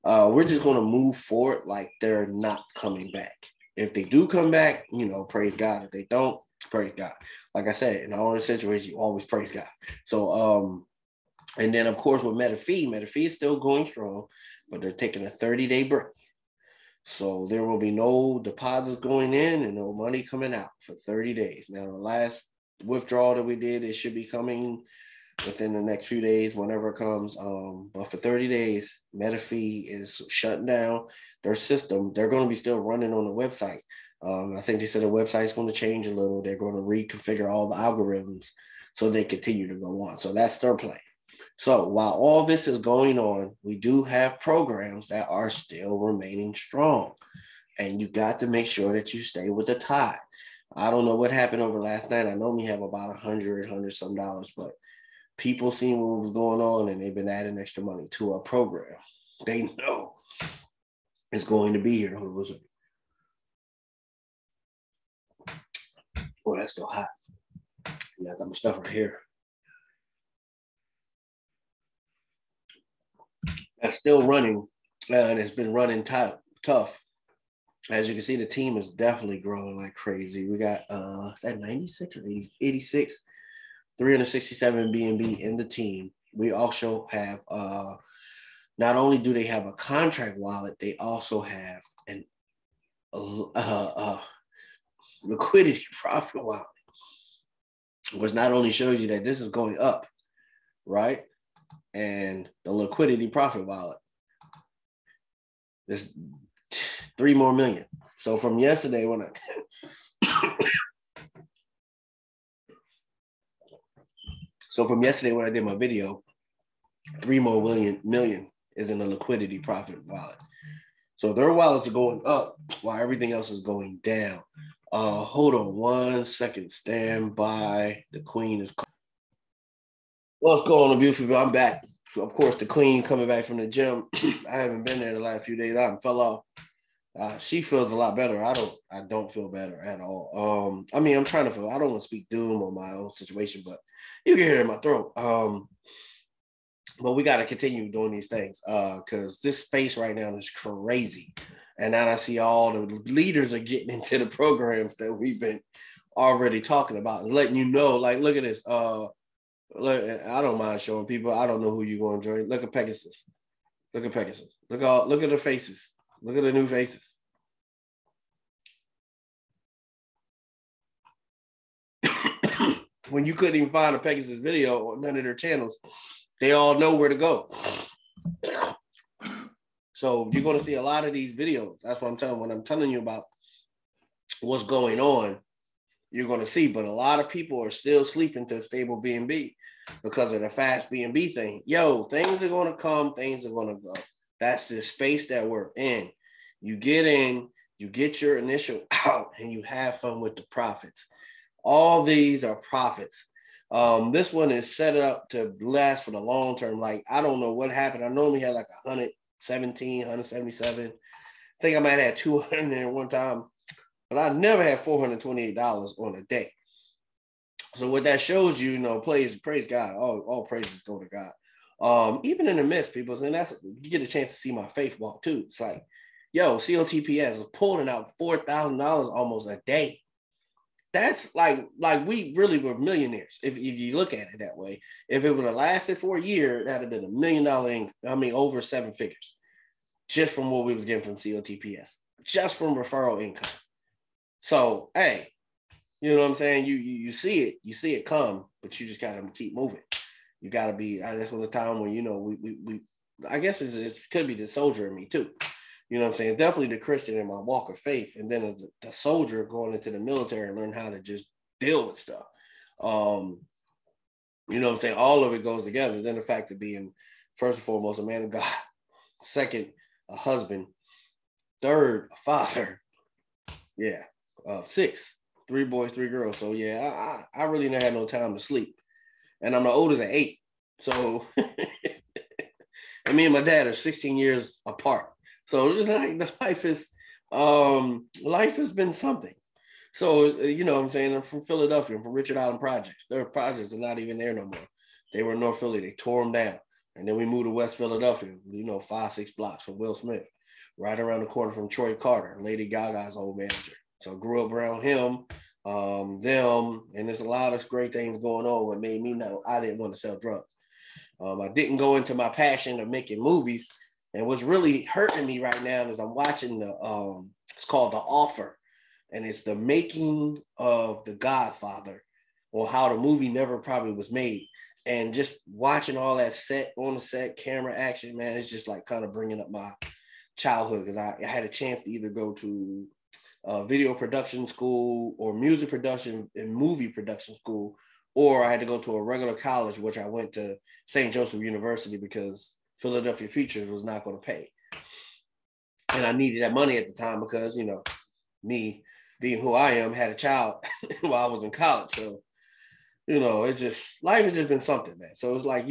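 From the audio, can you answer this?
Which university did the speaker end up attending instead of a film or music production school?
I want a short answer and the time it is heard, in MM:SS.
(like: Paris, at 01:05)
St. Joseph University, at 05:40.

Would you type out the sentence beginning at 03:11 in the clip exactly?
Yo, things are going to come, things are going to go.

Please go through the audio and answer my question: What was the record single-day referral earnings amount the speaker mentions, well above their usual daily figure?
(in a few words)
$428.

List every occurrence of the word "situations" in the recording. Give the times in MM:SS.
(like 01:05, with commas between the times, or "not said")
00:08, 02:23.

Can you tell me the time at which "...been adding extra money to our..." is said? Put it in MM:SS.
00:57.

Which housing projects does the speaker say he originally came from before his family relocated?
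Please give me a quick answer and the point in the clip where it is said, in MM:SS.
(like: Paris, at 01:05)
Richard Allen Projects, at 04:52.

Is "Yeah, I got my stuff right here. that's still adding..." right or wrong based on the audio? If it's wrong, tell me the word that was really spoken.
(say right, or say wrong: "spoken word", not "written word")
wrong: "running", not "adding".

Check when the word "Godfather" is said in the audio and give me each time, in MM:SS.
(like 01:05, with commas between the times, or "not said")
05:21.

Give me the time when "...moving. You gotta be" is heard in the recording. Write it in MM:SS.
04:09.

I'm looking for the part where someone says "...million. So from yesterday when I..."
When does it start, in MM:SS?
01:47.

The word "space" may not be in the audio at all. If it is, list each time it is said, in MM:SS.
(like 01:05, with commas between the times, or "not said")
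02:29, 03:14.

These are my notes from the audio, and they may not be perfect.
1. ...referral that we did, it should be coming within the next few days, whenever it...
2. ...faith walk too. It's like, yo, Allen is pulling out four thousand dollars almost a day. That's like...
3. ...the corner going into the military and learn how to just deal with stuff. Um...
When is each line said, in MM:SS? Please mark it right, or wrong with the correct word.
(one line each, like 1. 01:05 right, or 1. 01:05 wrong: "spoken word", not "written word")
1. 00:22 wrong: "withdrawal", not "referral"
2. 03:44 wrong: "COTPS", not "Allen"
3. 04:18 wrong: "soldier", not "corner".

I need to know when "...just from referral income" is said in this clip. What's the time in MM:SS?
04:02.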